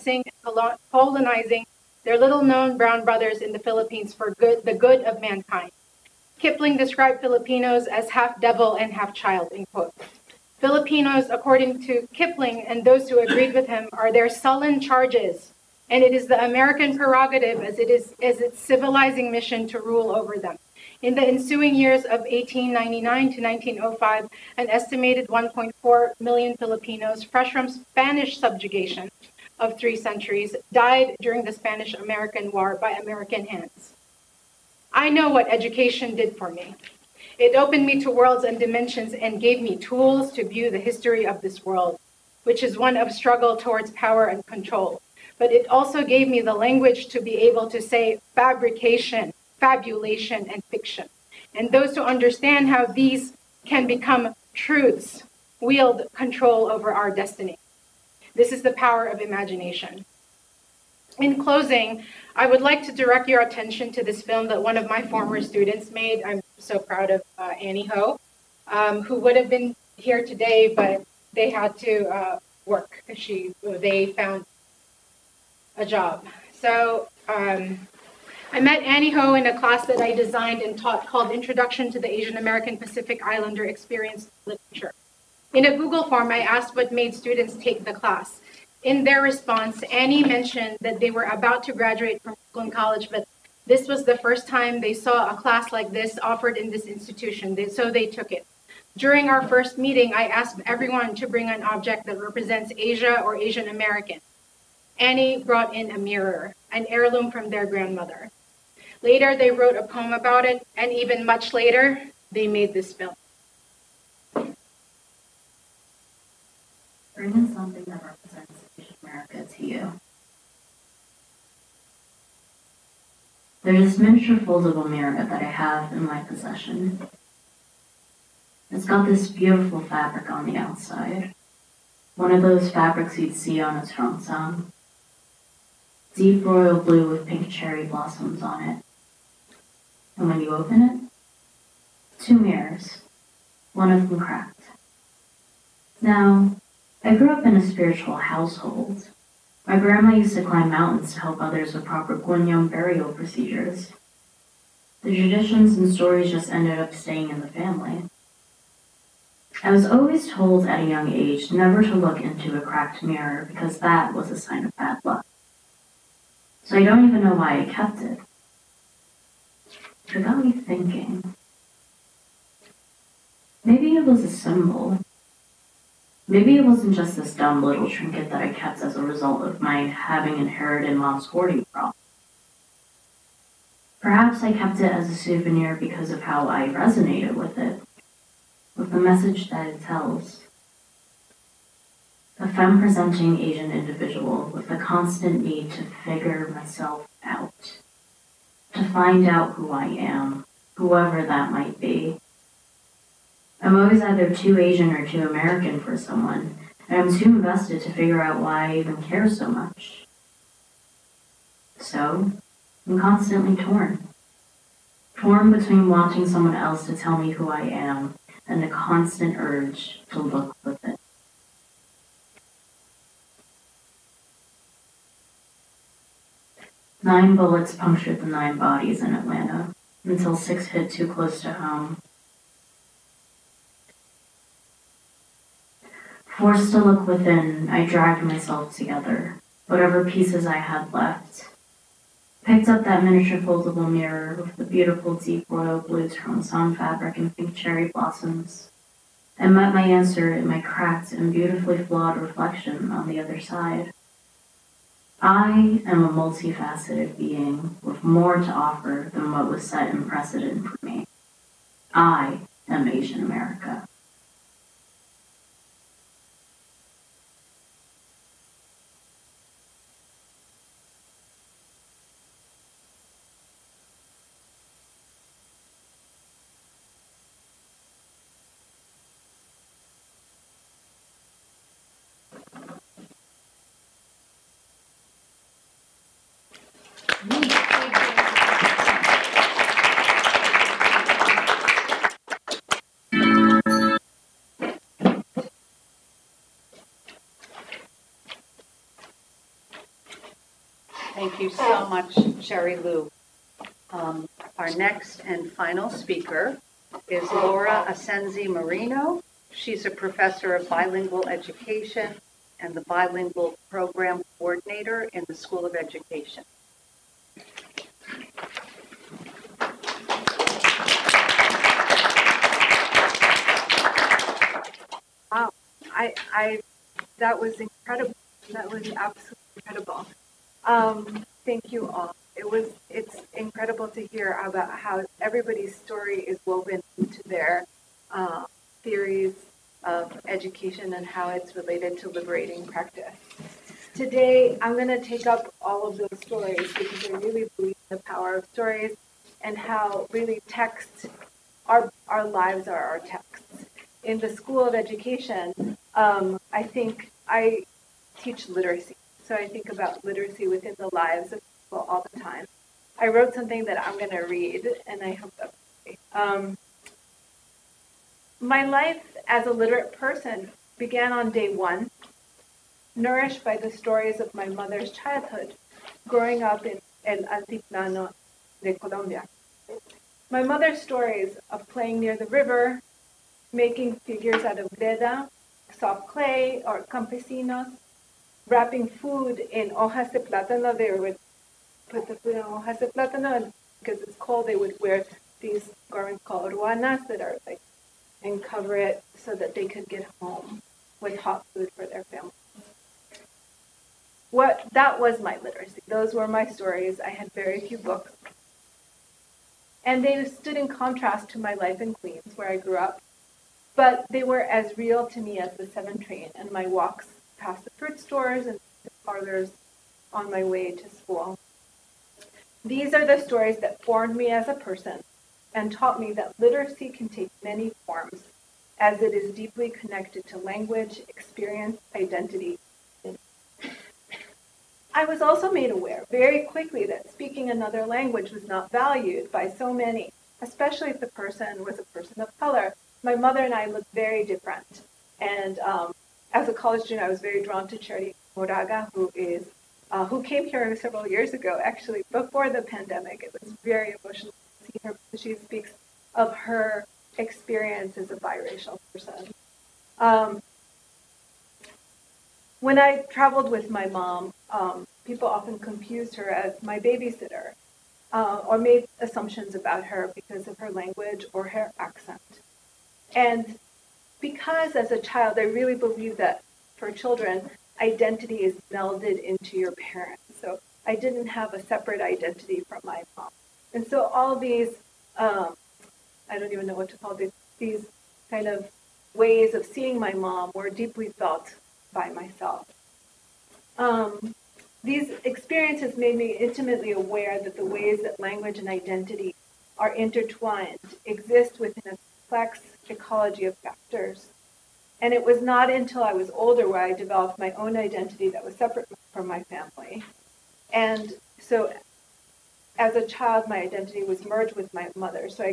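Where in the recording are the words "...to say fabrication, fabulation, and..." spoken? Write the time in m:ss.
0:47.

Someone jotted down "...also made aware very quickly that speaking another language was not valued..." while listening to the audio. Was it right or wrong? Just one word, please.
right.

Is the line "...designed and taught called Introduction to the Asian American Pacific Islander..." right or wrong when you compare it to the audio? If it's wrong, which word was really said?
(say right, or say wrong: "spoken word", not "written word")
right.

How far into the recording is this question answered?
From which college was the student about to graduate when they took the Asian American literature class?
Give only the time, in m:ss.
1:32.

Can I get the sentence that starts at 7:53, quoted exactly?
And because as a child, I really believe that for children, identity is melded into your parents.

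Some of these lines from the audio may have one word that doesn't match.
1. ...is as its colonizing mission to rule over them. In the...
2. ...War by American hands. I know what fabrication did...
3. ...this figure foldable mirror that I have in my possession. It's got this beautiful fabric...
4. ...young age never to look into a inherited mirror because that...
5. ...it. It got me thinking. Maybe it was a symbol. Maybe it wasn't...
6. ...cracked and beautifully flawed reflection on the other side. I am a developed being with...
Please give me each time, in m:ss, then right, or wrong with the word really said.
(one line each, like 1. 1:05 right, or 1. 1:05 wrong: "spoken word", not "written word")
1. 0:17 wrong: "civilizing", not "colonizing"
2. 0:32 wrong: "education", not "fabrication"
3. 2:03 wrong: "miniature", not "figure"
4. 2:40 wrong: "cracked", not "inherited"
5. 2:48 right
6. 4:10 wrong: "multifaceted", not "developed".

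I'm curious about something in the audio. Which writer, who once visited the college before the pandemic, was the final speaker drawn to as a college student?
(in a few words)
Cherríe Moraga.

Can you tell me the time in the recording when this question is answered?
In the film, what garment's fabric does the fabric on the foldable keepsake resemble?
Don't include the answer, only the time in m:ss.
2:13.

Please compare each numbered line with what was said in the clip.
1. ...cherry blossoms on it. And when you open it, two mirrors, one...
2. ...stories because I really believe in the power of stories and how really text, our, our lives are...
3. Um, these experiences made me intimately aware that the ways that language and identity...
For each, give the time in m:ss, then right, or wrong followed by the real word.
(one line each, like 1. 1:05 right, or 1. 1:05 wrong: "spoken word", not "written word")
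1. 2:17 right
2. 5:46 right
3. 8:13 right.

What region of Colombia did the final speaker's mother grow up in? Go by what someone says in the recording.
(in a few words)
El Altiplano.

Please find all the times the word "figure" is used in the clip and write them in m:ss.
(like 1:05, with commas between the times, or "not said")
3:16, 3:27, 6:23.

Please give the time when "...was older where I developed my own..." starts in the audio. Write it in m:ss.
8:26.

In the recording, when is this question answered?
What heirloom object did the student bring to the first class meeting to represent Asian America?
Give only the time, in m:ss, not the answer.
1:45.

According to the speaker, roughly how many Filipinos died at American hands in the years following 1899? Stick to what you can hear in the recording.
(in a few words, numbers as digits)
1.4 million.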